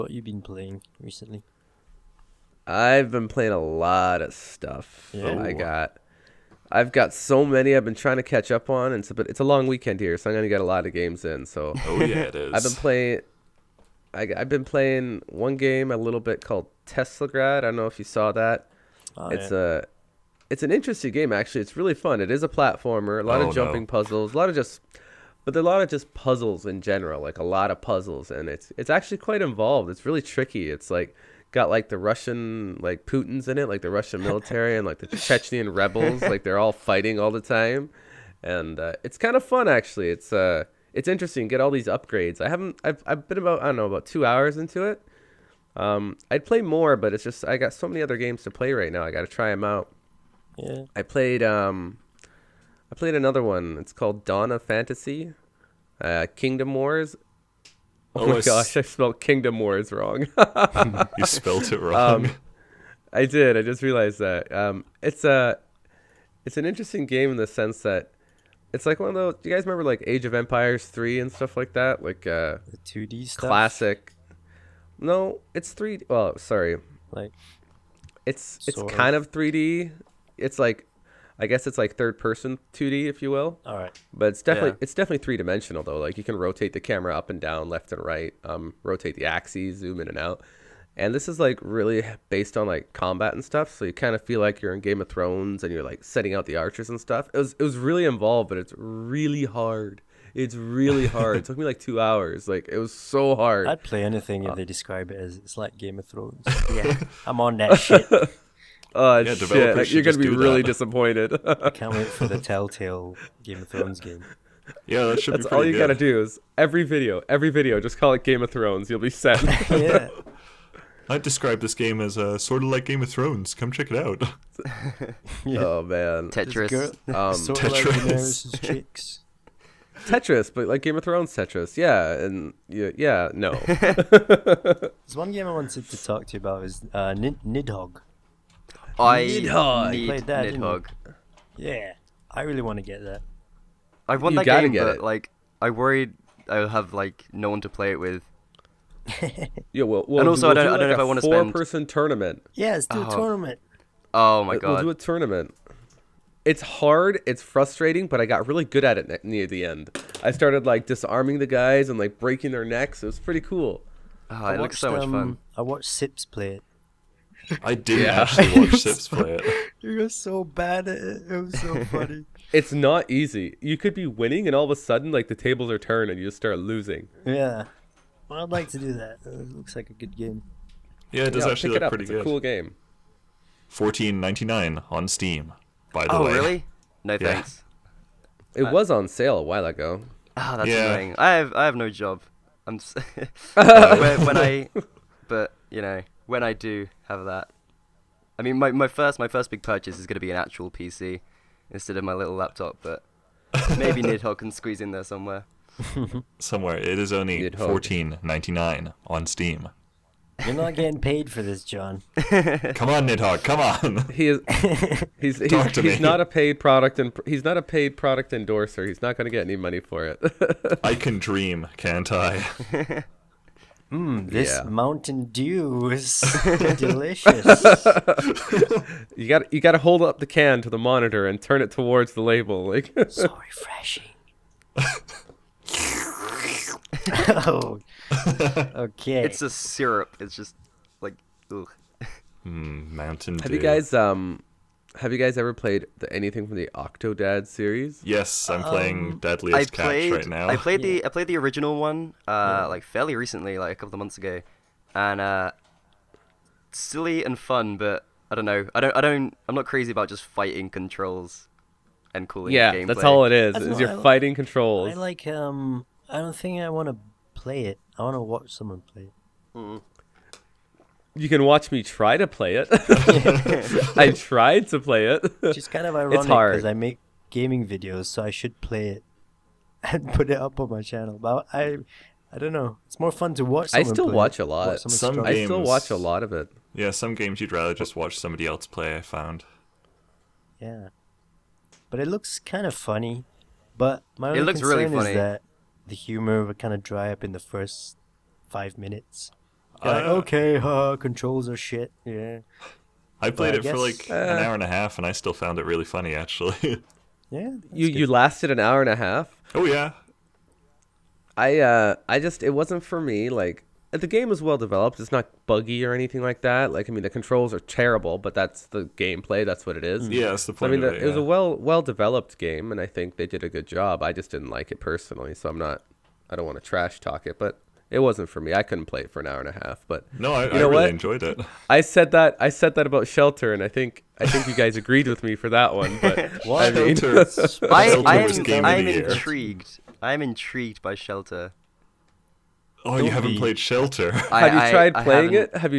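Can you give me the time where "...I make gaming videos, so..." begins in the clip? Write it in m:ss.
4:36.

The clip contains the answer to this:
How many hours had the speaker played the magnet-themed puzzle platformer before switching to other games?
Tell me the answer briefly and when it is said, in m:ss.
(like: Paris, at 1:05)
2 hours, at 0:43.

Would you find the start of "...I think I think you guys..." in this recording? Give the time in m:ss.
5:33.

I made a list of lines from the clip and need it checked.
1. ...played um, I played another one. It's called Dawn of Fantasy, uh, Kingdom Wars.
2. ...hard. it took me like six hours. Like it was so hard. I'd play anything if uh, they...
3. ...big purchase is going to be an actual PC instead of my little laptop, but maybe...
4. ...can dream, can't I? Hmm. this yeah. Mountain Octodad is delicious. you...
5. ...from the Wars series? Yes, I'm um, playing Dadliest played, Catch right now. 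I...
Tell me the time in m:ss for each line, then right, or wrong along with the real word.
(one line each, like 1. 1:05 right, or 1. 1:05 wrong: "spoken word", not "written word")
1. 0:51 right
2. 1:41 wrong: "two", not "six"
3. 3:19 right
4. 3:40 wrong: "Dew", not "Octodad"
5. 4:06 wrong: "Octodad", not "Wars".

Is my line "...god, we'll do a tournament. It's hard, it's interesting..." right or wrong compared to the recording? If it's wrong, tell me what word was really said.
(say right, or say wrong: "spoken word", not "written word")
wrong: "frustrating", not "interesting".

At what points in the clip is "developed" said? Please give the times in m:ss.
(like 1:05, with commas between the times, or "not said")
5:14, 5:21.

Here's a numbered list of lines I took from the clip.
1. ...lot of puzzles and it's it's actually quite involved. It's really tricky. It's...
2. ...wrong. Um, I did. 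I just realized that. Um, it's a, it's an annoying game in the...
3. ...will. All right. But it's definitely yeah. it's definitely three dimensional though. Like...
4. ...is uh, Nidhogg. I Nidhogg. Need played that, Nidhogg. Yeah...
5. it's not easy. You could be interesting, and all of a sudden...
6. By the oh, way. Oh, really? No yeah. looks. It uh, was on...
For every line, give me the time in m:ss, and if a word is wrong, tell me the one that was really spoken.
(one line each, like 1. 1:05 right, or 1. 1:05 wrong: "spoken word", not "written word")
1. 0:27 right
2. 1:01 wrong: "interesting", not "annoying"
3. 1:23 right
4. 2:16 right
5. 2:52 wrong: "winning", not "interesting"
6. 3:05 wrong: "thanks", not "looks".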